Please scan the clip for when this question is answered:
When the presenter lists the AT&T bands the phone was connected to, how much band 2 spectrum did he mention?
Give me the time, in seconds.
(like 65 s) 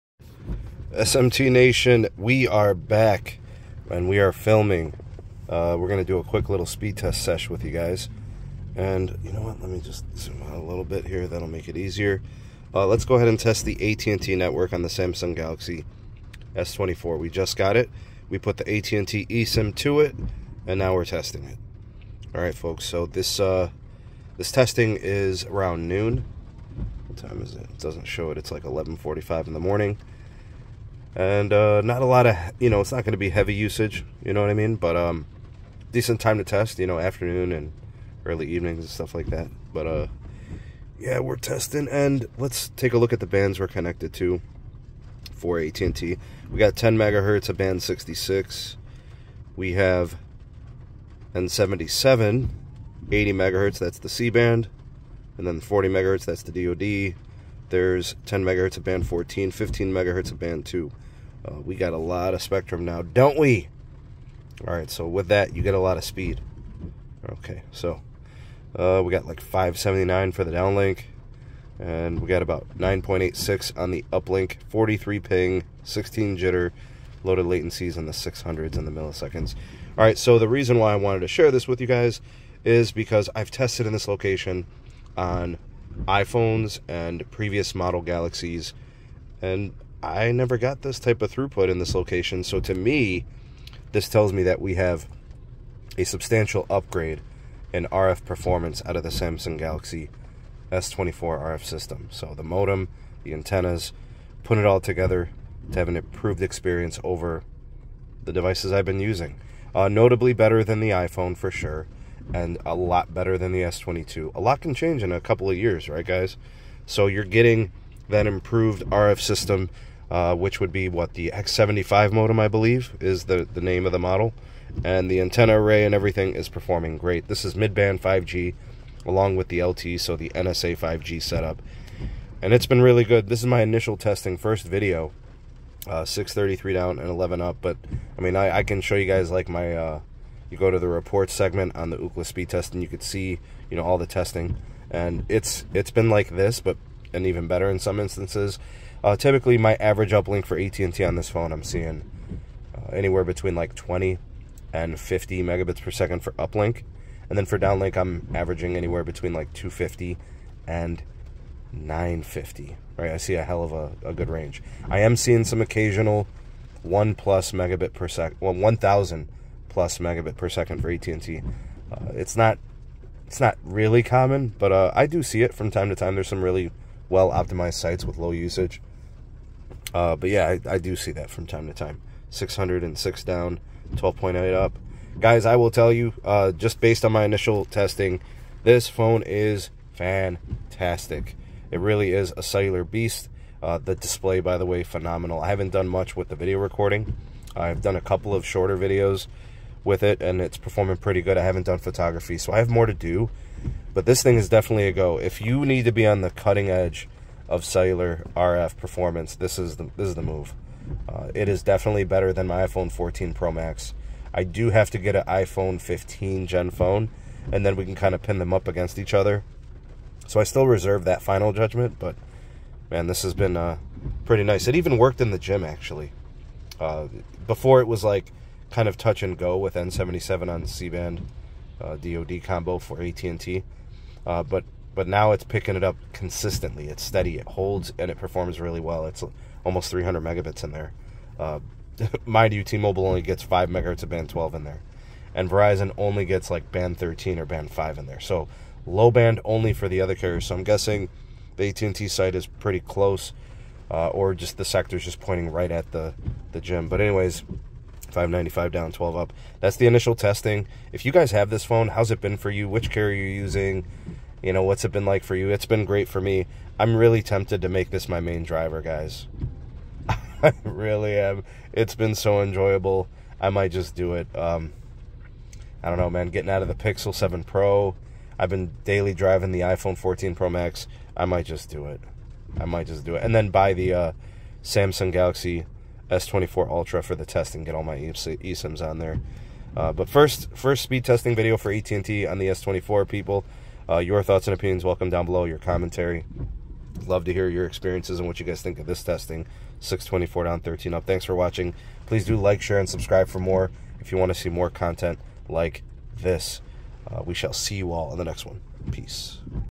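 59 s.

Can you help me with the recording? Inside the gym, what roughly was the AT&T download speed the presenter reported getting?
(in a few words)
almost 300 Mbps.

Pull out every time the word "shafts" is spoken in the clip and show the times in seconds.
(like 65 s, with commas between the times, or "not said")
not said.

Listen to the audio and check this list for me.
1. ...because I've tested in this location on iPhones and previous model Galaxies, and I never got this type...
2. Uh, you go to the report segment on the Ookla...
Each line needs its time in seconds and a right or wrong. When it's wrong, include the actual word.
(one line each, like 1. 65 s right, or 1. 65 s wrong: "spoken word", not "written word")
1. 82 s right
2. 139 s right.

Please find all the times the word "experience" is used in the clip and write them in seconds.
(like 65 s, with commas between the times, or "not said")
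106 s, 297 s.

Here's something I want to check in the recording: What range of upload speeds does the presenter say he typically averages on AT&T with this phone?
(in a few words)
20 to 50 Mbps.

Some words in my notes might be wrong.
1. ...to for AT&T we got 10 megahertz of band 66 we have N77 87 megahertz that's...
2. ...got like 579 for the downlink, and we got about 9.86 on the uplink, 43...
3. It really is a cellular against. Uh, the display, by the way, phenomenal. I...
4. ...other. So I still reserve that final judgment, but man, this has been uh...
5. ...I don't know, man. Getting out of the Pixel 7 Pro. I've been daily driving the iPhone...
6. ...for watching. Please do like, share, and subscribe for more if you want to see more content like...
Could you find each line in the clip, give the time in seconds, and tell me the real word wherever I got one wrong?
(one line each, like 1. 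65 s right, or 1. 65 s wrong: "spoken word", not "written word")
1. 44 s wrong: "80", not "87"
2. 69 s right
3. 191 s wrong: "beast", not "against"
4. 219 s right
5. 275 s right
6. 301 s right.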